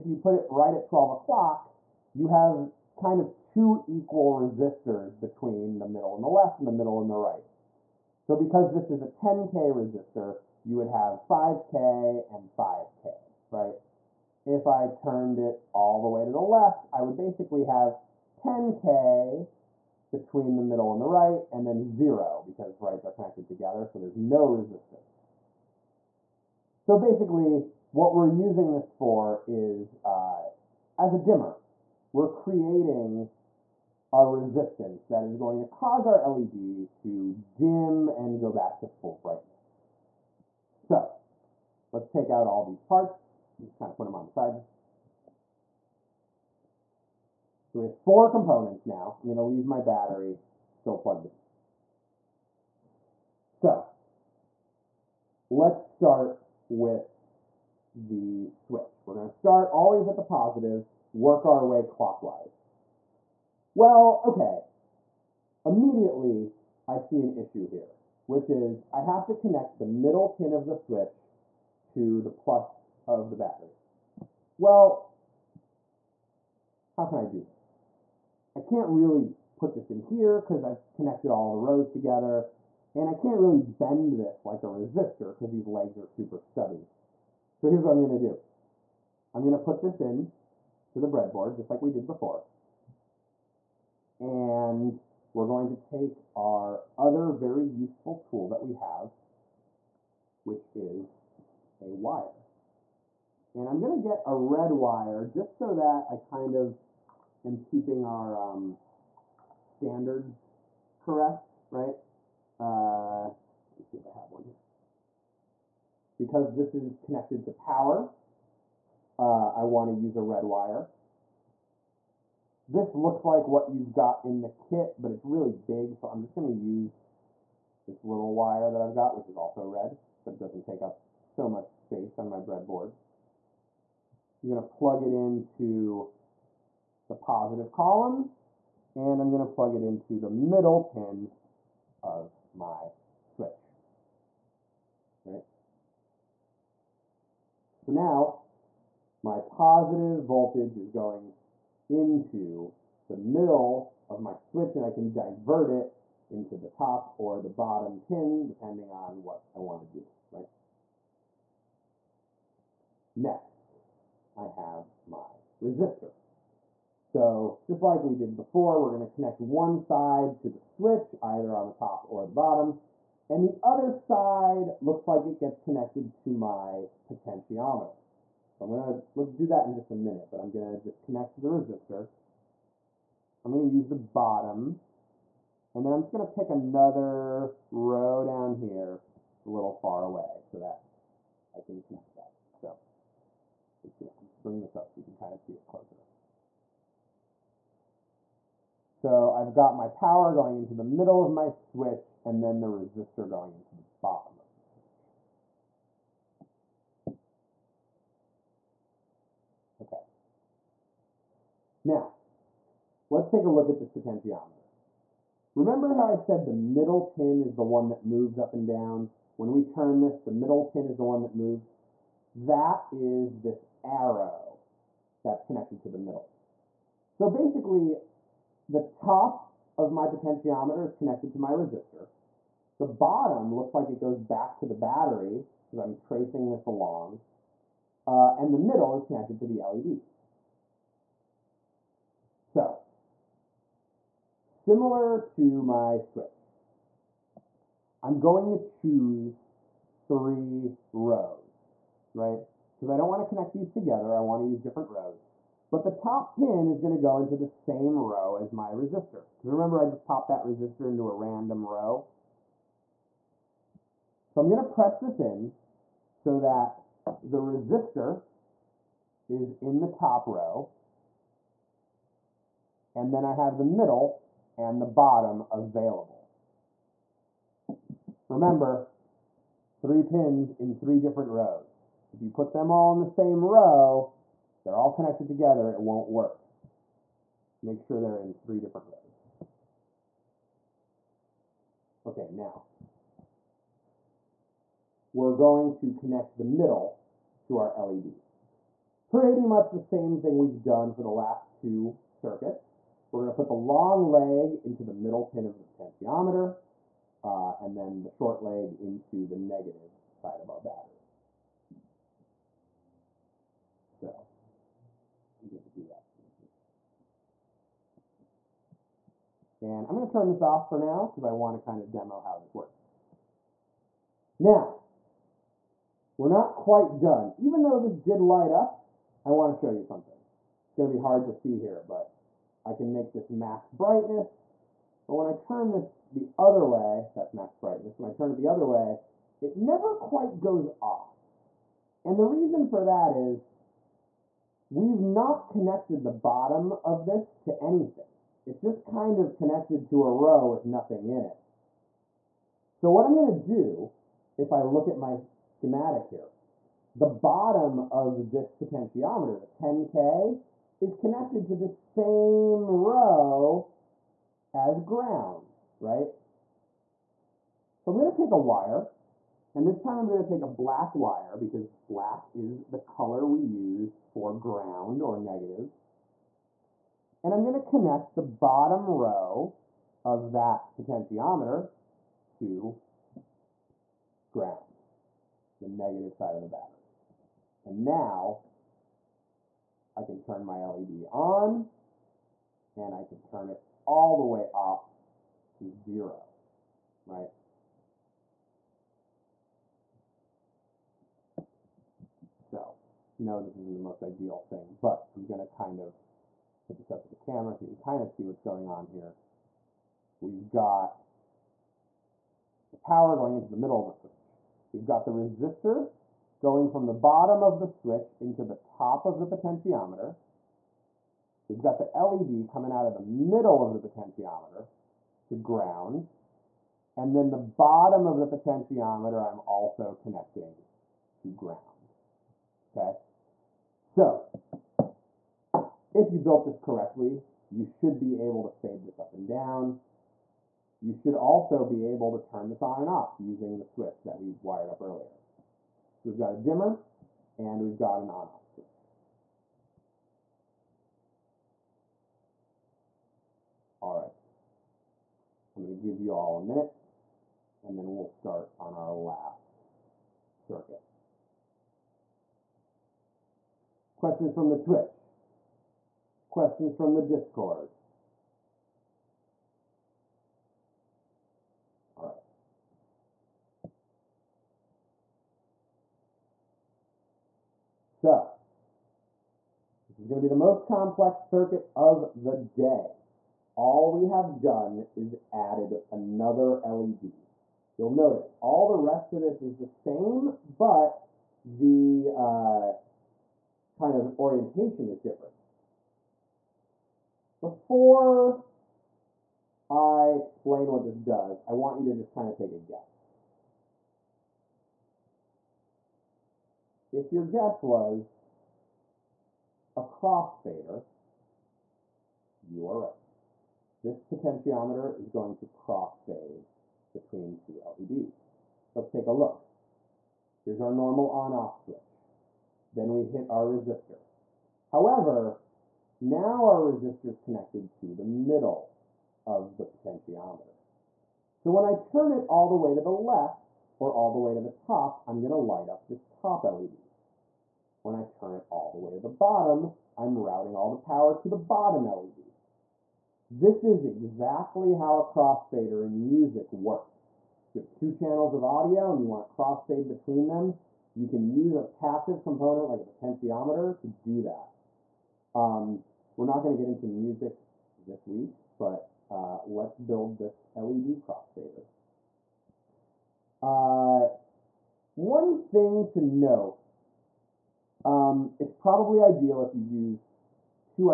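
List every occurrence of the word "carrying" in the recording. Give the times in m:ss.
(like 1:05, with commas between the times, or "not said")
not said.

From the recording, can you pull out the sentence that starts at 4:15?
But the top pin is going to go into the same row as my resistor.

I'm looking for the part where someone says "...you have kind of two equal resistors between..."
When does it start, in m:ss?
0:02.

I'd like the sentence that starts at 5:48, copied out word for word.
It's just kind of connected to a row with nothing in it.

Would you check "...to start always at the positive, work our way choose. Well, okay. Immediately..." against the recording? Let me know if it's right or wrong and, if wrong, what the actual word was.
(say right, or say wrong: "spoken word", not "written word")
wrong: "clockwise", not "choose".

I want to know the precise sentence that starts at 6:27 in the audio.
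And now I can turn my LED on and I can turn it all the way off to zero, right?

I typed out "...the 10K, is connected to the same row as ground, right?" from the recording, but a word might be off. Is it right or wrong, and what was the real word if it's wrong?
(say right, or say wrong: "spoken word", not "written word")
right.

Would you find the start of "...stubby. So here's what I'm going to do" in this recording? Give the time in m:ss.
1:26.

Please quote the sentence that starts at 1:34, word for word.
And we're going to take our other very useful tool that we have, which is a wire.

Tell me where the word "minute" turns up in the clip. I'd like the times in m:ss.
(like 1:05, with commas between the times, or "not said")
2:59, 7:36.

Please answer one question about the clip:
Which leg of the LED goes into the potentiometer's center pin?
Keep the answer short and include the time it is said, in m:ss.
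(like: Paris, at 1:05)
long leg, at 5:03.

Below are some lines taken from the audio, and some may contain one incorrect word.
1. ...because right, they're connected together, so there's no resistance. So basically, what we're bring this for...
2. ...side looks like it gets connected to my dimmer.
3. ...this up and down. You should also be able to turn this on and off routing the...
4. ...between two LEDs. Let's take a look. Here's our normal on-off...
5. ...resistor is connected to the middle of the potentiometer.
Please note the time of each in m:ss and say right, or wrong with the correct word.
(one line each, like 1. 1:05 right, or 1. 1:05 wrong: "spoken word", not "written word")
1. 0:22 wrong: "using", not "bring"
2. 2:53 wrong: "potentiometer", not "dimmer"
3. 7:18 wrong: "using", not "routing"
4. 8:36 right
5. 8:46 right.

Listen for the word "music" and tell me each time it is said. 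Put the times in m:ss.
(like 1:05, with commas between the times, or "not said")
9:06, 9:16.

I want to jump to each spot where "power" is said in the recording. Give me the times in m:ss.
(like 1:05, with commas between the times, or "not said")
1:57, 3:19, 6:52, 9:00.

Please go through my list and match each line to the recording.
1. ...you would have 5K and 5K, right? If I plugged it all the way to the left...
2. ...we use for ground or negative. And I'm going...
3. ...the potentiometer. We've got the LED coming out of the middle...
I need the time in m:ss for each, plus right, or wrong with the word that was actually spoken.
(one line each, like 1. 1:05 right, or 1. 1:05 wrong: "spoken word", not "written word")
1. 0:10 wrong: "turned", not "plugged"
2. 6:13 right
3. 6:59 right.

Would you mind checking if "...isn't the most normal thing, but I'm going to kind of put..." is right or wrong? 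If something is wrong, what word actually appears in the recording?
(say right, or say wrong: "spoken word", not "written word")
wrong: "ideal", not "normal".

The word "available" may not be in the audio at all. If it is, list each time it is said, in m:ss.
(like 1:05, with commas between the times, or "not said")
4:35.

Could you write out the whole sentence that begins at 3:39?
When we turn this, the middle pin is the one that moves.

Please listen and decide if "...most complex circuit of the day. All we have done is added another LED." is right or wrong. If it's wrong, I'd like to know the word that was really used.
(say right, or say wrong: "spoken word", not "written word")
right.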